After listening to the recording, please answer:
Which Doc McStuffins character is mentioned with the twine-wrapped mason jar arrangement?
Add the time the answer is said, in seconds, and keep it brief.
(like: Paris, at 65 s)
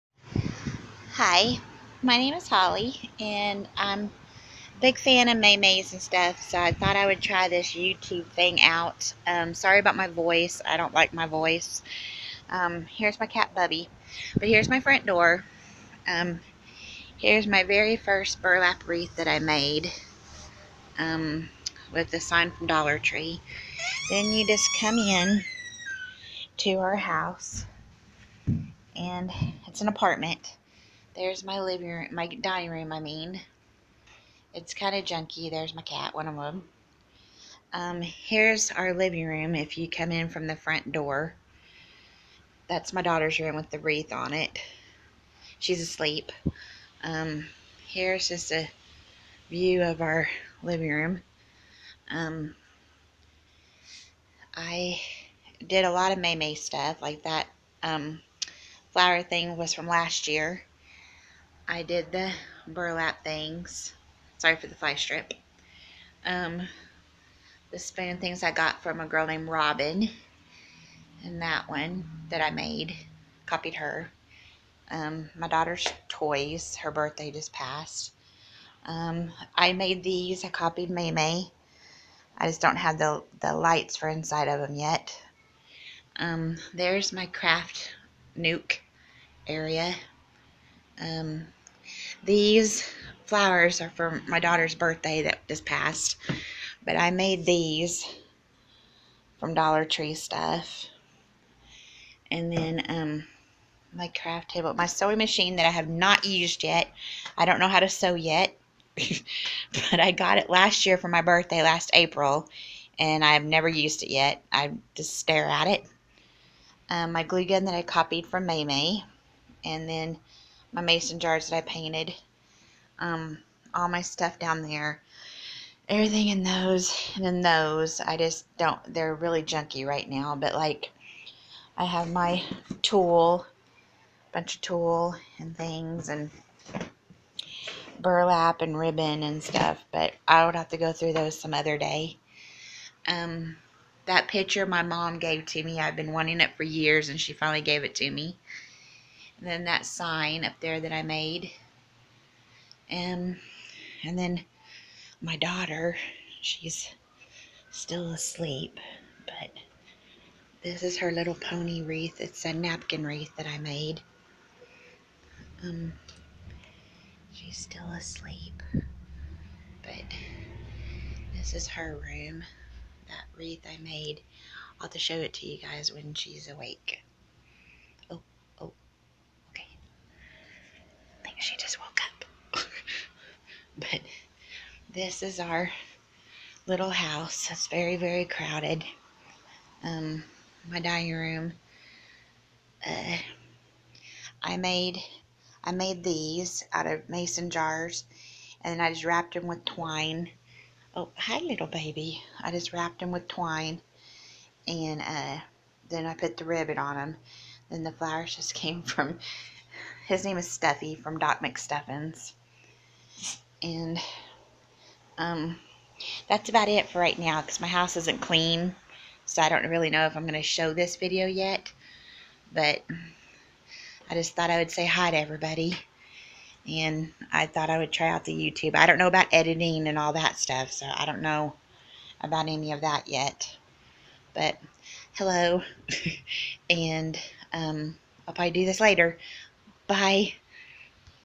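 Stuffy, at 210 s.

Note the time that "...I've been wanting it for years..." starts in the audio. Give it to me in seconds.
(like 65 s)
145 s.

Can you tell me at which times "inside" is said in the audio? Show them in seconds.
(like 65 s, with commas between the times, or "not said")
84 s.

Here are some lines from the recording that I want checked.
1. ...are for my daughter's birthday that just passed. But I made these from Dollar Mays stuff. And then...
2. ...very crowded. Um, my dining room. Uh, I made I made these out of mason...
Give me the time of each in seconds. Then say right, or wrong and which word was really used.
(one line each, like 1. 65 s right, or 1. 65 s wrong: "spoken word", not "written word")
1. 93 s wrong: "Tree", not "Mays"
2. 187 s right.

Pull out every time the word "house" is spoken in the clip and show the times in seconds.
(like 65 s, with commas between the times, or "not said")
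26 s, 186 s, 217 s.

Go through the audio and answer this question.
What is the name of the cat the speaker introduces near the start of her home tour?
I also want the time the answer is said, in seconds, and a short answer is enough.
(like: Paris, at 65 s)
Bubby, at 13 s.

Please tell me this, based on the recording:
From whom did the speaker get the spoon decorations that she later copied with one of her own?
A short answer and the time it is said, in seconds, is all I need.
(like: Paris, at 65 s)
Robin, at 69 s.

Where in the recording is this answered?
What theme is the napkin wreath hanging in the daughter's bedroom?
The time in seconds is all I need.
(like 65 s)
161 s.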